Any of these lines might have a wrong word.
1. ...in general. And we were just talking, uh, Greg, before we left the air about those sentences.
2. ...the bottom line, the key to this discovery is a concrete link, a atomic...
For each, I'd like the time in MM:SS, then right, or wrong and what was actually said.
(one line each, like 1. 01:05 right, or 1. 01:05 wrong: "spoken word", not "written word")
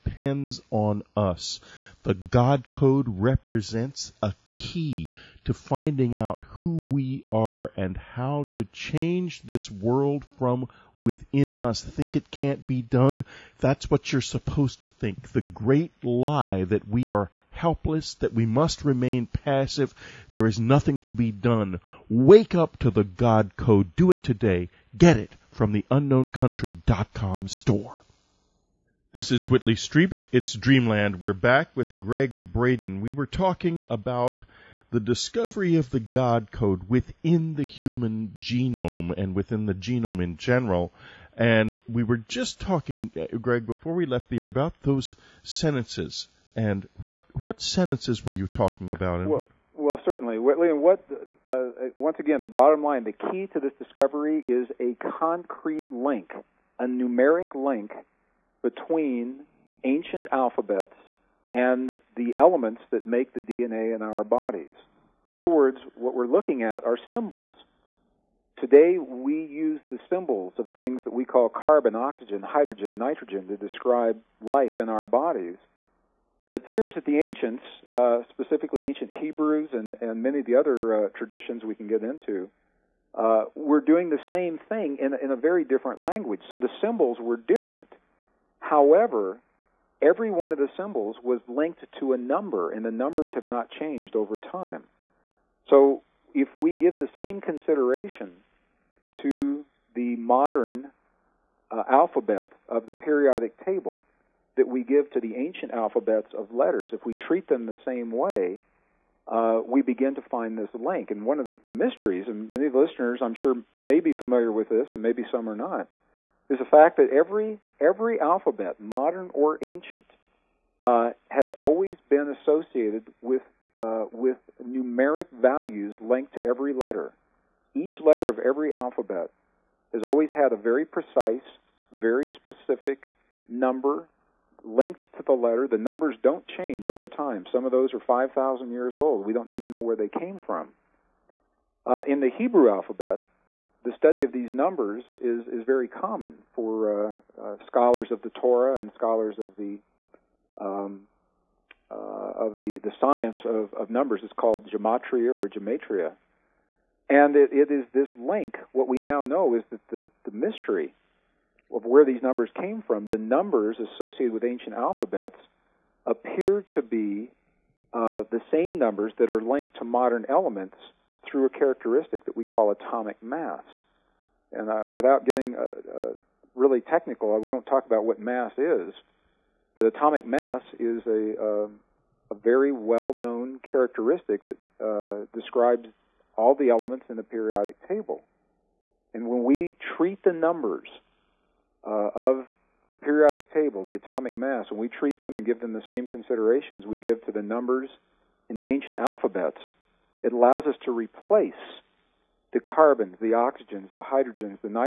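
1. 00:40 right
2. 00:52 wrong: "numeric", not "atomic".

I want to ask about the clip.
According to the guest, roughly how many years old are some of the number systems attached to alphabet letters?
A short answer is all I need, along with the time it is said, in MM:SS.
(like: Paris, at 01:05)
5,000, at 02:17.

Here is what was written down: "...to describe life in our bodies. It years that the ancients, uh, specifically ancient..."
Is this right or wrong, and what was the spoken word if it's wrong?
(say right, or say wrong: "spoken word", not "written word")
wrong: "appears", not "years".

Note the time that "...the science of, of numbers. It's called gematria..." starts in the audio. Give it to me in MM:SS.
02:32.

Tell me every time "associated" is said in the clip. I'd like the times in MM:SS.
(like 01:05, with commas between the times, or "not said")
02:02, 02:43.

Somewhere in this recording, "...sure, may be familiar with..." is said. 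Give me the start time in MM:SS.
01:53.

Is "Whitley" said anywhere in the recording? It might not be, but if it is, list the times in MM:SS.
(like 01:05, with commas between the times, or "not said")
00:29.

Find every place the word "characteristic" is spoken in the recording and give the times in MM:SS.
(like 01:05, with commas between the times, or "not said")
02:51, 03:03.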